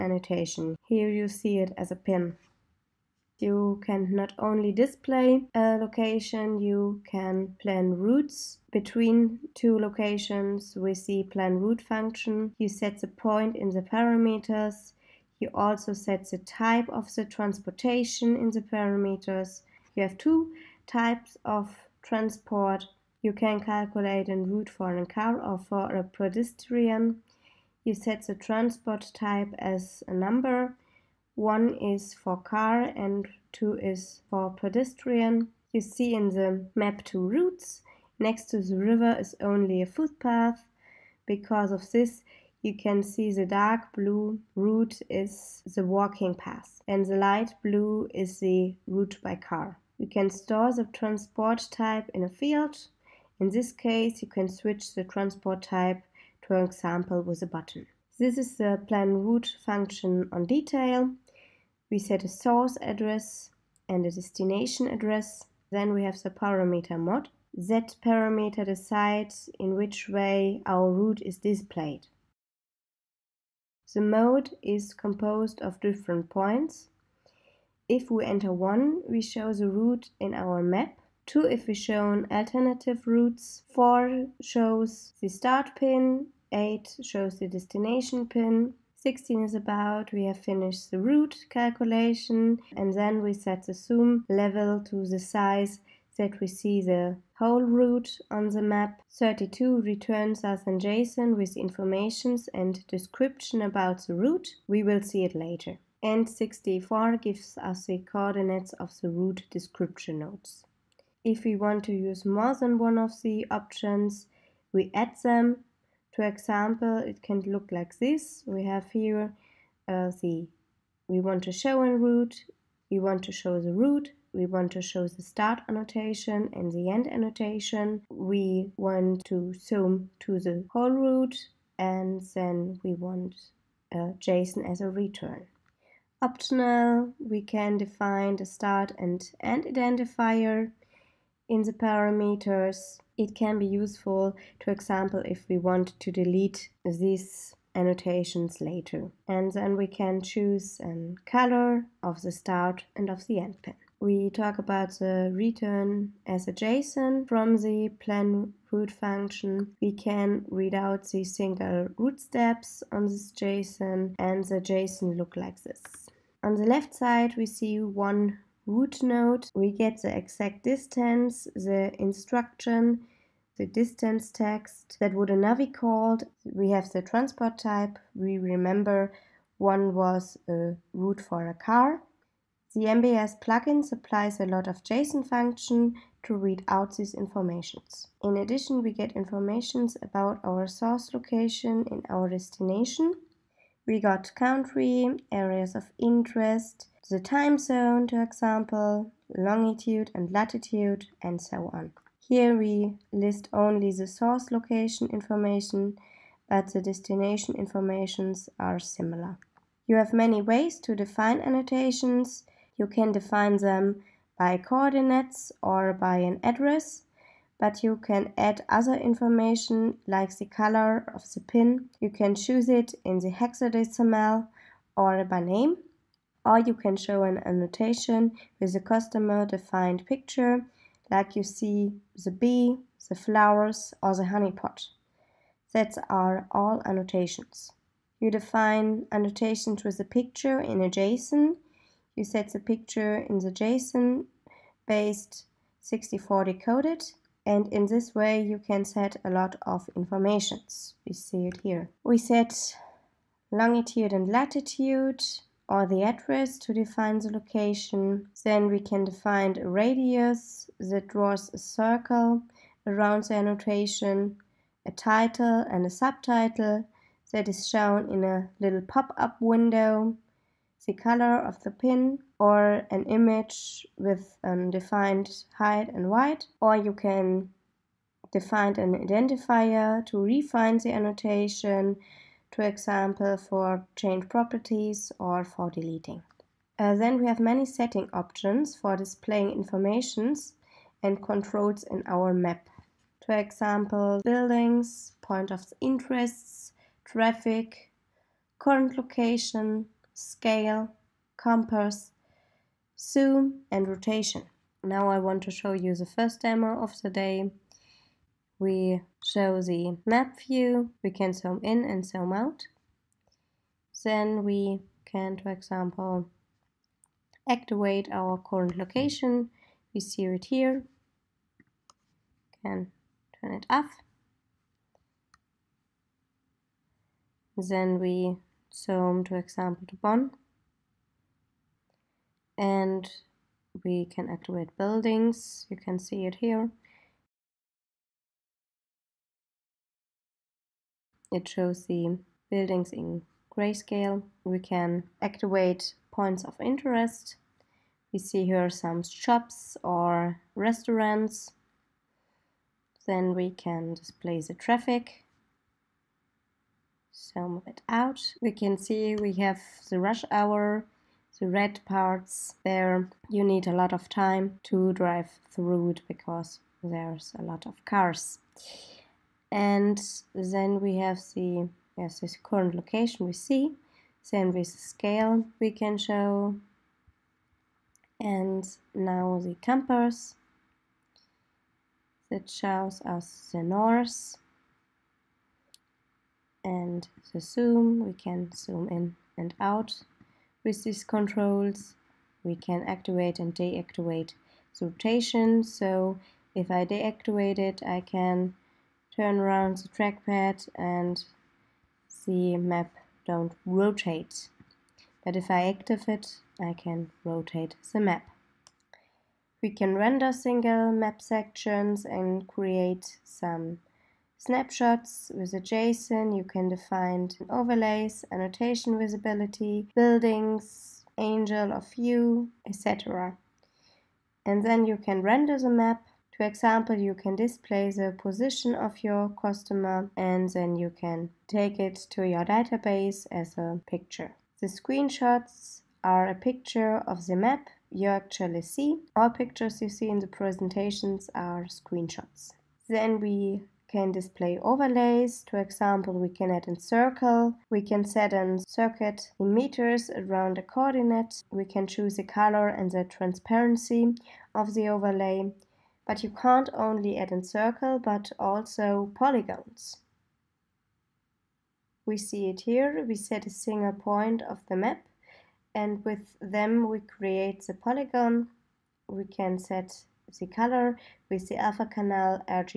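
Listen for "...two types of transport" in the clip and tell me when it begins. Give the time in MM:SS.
00:20.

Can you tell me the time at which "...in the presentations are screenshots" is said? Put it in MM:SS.
07:20.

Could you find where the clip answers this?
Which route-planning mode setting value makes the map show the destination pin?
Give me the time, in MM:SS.
01:26.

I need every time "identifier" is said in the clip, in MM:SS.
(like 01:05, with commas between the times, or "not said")
02:19, 04:39.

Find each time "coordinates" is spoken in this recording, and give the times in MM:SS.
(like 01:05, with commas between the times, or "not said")
01:48, 03:34, 07:30.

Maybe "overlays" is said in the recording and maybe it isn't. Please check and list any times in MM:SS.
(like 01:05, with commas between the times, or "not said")
06:57, 07:24, 07:34.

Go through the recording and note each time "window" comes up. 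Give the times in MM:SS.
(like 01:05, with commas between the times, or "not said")
04:29.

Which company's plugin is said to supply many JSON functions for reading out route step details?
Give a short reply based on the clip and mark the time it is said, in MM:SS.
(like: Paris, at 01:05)
MBS, at 03:02.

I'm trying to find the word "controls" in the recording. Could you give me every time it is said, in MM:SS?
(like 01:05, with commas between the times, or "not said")
04:51, 06:31.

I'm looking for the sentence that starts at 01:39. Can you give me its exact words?
32 returns us in JSON with informations and description about the route.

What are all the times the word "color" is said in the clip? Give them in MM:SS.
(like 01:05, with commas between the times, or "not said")
02:31, 03:40, 04:30, 07:32, 07:50.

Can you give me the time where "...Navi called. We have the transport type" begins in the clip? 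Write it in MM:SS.
02:55.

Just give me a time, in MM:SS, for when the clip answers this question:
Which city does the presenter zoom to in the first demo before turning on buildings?
05:29.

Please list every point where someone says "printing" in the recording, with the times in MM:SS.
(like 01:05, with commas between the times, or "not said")
not said.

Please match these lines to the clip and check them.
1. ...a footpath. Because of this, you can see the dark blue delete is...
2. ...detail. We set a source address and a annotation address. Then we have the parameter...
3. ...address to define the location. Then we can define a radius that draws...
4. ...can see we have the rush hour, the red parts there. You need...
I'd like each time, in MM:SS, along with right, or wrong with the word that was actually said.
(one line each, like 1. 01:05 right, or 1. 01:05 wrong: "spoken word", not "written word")
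1. 00:39 wrong: "route", not "delete"
2. 01:00 wrong: "destination", not "annotation"
3. 04:16 right
4. 05:58 right.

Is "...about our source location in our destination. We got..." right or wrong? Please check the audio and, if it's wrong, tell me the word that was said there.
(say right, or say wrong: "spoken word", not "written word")
right.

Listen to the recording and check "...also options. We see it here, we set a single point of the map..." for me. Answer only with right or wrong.
wrong.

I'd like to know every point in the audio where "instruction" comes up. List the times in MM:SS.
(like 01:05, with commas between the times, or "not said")
02:52.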